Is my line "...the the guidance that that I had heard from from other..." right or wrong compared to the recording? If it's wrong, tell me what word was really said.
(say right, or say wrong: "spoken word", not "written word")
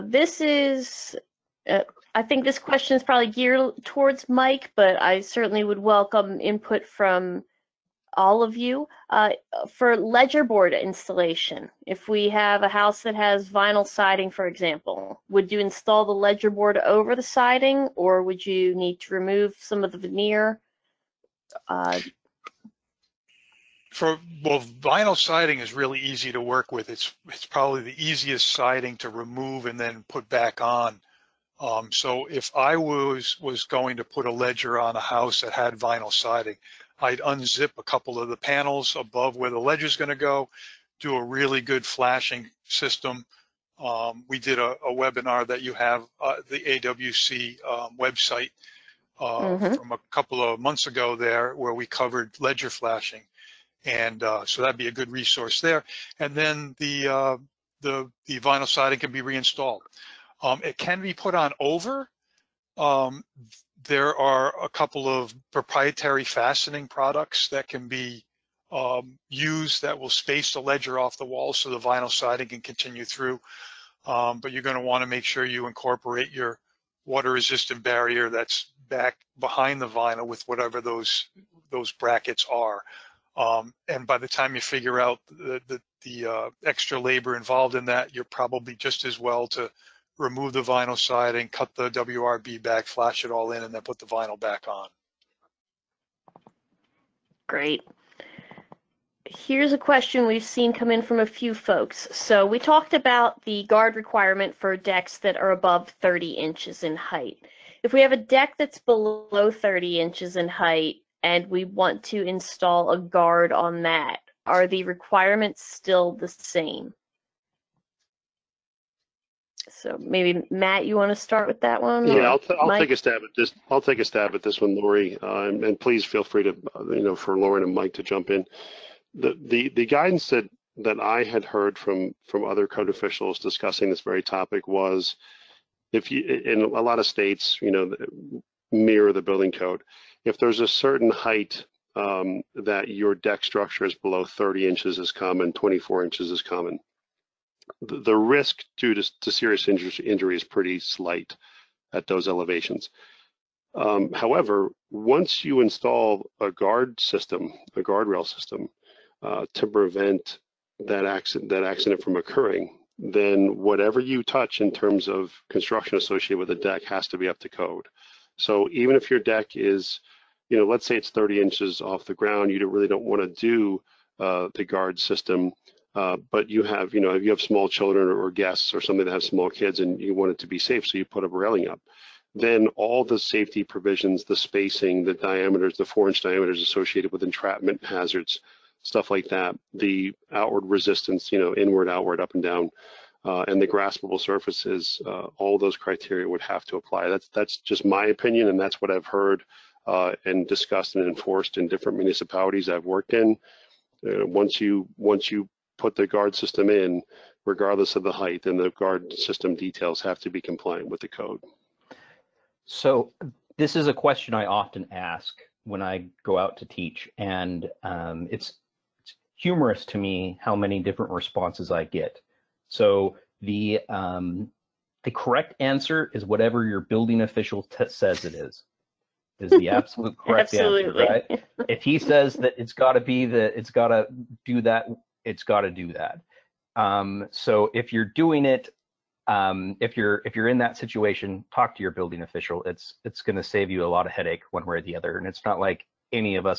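right.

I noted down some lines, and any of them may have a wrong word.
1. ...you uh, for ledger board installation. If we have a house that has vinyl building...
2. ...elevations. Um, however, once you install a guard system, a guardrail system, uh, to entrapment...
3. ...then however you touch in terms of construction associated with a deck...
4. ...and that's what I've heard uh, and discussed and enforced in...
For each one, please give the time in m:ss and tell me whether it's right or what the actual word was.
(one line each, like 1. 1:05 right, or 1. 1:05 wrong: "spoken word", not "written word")
1. 0:08 wrong: "siding", not "building"
2. 2:32 wrong: "prevent", not "entrapment"
3. 2:42 wrong: "whatever", not "however"
4. 3:18 right.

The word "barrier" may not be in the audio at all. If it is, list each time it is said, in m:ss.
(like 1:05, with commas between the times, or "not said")
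1:17.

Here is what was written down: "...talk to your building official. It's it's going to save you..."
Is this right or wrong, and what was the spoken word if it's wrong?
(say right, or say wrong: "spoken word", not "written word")
right.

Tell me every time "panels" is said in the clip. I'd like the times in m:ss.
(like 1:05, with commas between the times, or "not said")
0:38.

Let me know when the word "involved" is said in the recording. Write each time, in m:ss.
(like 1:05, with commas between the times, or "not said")
1:27.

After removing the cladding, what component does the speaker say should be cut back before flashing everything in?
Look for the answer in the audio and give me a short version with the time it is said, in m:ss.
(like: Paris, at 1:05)
WRB, at 1:31.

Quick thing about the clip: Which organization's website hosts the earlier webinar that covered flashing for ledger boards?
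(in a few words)
AWC.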